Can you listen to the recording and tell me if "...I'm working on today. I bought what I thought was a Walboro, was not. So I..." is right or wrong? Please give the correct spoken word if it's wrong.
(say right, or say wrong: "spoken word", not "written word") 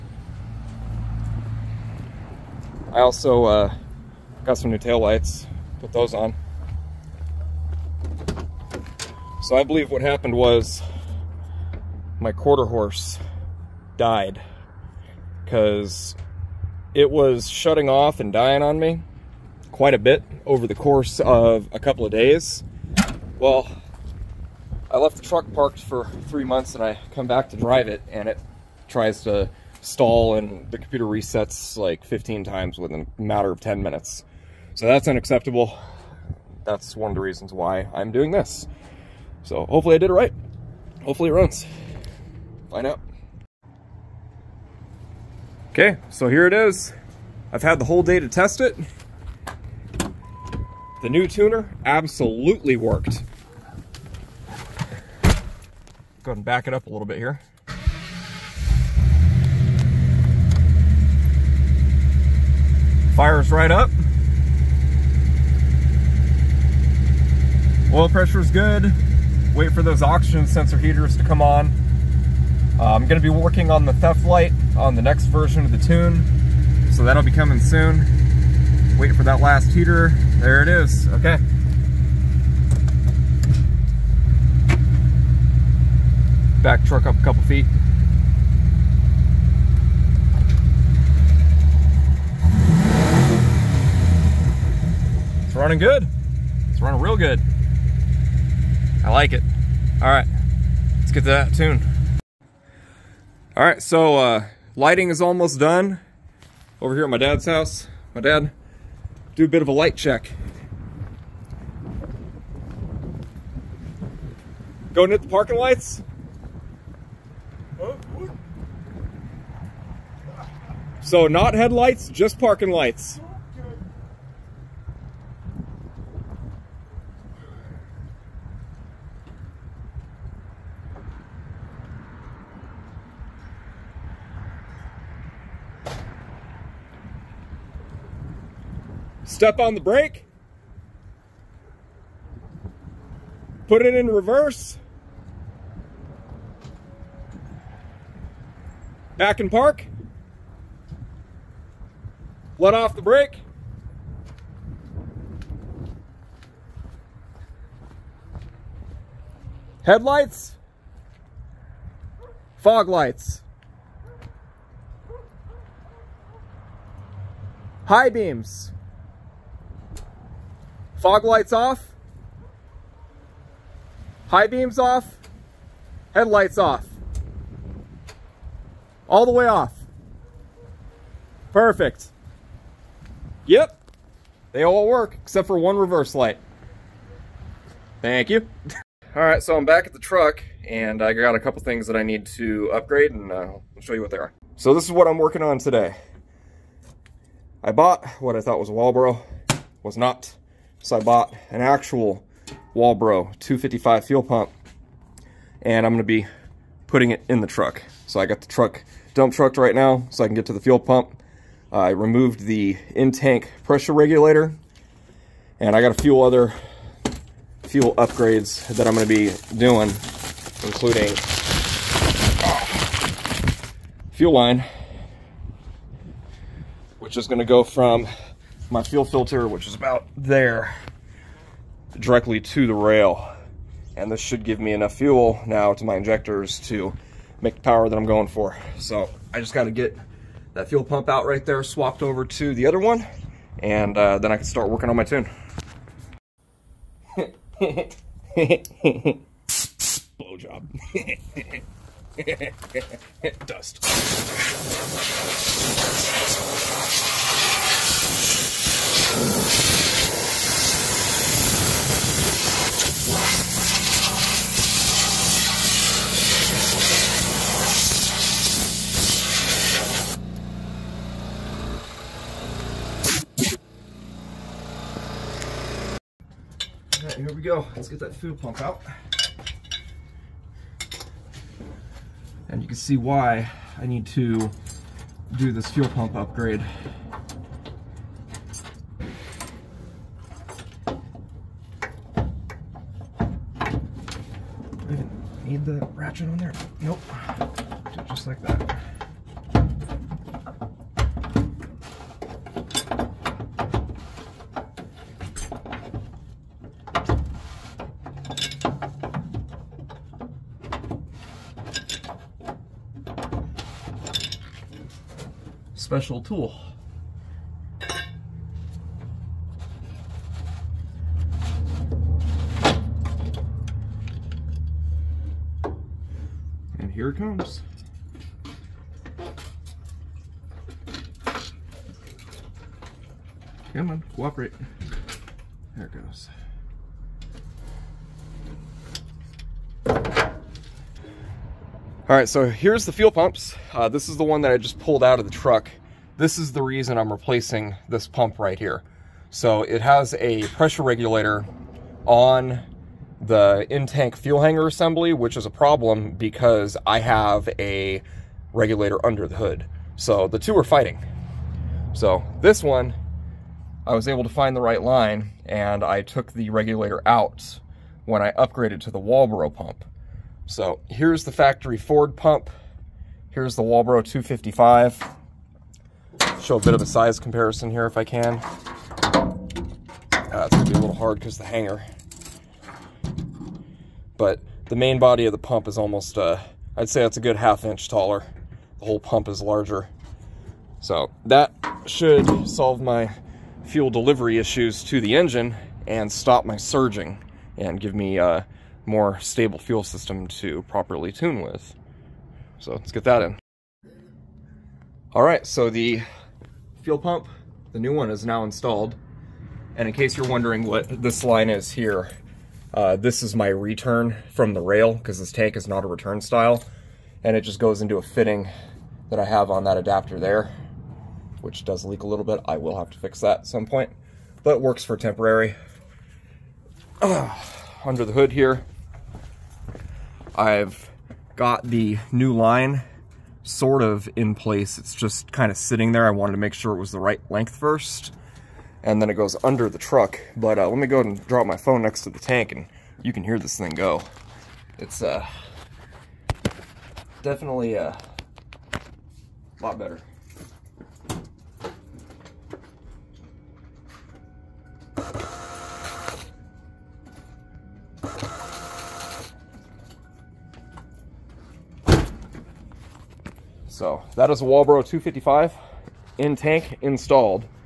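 right.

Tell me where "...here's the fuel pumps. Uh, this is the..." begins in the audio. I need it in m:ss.
5:42.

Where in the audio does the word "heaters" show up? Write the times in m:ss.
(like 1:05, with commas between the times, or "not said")
1:10, 1:19.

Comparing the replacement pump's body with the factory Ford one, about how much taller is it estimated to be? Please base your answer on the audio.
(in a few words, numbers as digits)
half inch.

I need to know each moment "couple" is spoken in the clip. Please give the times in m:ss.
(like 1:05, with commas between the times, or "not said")
0:21, 1:27, 3:11.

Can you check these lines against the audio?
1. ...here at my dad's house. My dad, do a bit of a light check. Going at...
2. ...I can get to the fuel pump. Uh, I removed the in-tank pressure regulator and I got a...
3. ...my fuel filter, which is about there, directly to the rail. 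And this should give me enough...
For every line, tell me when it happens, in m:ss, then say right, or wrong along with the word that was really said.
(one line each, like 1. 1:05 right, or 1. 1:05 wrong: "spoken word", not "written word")
1. 1:46 right
2. 3:30 right
3. 3:48 right.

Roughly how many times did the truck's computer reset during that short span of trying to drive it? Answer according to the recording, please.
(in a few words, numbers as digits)
15.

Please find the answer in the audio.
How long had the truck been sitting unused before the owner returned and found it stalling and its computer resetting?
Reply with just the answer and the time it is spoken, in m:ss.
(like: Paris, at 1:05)
3 months, at 0:26.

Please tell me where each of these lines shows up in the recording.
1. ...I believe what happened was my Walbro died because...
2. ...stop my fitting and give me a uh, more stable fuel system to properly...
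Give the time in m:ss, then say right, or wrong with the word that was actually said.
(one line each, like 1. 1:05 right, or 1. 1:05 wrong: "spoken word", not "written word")
1. 0:09 wrong: "QuarterHorse", not "Walbro"
2. 6:36 wrong: "surging", not "fitting".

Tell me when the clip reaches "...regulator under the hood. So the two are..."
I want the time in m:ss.
5:58.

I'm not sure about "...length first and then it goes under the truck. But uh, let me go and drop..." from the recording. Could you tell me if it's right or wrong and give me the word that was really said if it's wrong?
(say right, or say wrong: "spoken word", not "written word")
right.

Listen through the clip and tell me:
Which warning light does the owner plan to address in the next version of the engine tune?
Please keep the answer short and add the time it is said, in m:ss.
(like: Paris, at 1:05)
theft light, at 1:13.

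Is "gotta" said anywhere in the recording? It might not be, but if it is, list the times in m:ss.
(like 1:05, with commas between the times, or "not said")
3:59.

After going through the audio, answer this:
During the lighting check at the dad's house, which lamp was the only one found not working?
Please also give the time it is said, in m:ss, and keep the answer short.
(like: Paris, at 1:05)
one reverse light, at 3:05.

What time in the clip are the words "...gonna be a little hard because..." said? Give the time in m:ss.
6:20.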